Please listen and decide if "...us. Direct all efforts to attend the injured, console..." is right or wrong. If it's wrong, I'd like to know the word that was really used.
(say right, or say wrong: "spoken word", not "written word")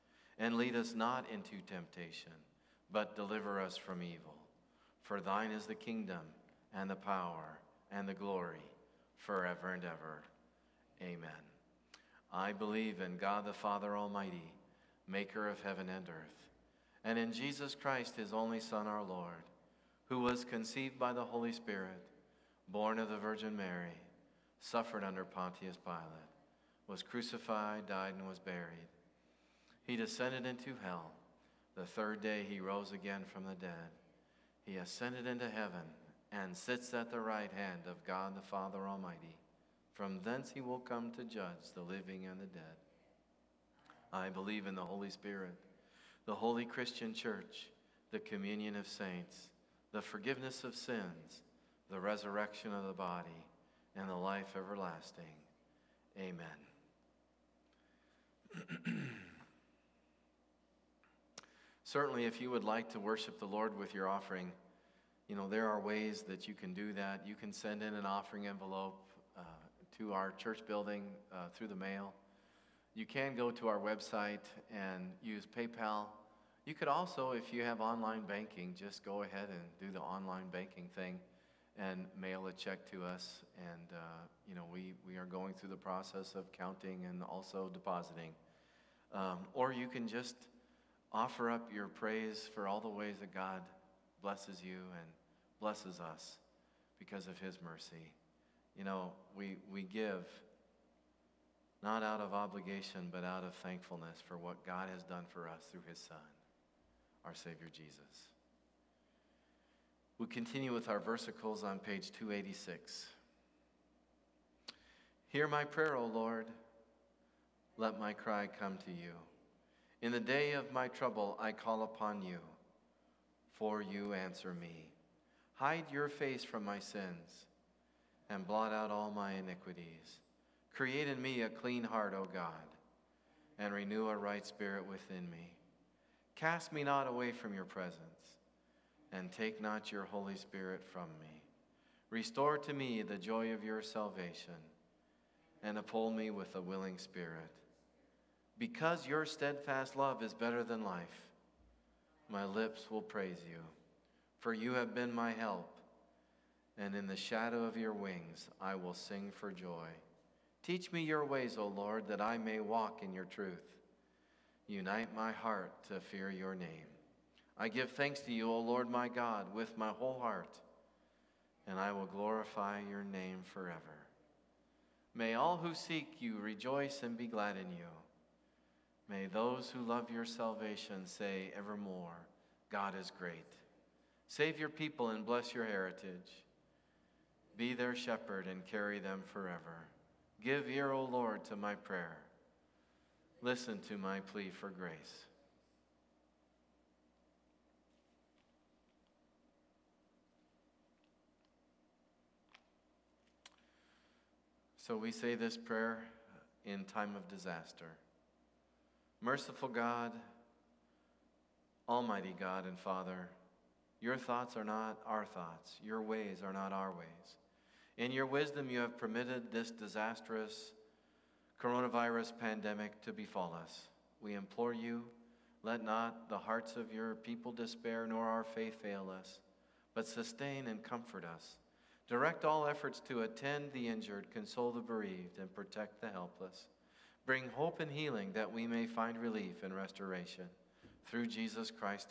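right.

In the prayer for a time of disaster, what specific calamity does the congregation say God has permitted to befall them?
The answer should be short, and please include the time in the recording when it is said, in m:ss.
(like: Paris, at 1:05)
coronavirus pandemic, at 3:41.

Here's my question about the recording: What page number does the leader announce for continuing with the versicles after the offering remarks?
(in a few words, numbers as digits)
286.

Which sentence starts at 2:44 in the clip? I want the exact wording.
Unite my heart to fear your name.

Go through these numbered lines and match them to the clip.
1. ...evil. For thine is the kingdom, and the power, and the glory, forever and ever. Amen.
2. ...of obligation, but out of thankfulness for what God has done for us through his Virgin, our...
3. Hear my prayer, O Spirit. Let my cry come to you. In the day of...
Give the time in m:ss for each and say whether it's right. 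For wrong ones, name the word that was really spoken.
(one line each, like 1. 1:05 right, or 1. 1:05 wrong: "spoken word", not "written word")
1. 0:04 right
2. 1:42 wrong: "Son", not "Virgin"
3. 1:55 wrong: "Lord", not "Spirit".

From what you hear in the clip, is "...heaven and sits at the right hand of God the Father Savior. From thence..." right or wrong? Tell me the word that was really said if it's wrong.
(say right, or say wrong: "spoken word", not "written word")
wrong: "Almighty", not "Savior".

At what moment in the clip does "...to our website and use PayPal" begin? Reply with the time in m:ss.
1:13.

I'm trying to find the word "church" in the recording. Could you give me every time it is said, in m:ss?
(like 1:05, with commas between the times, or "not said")
0:47, 1:10.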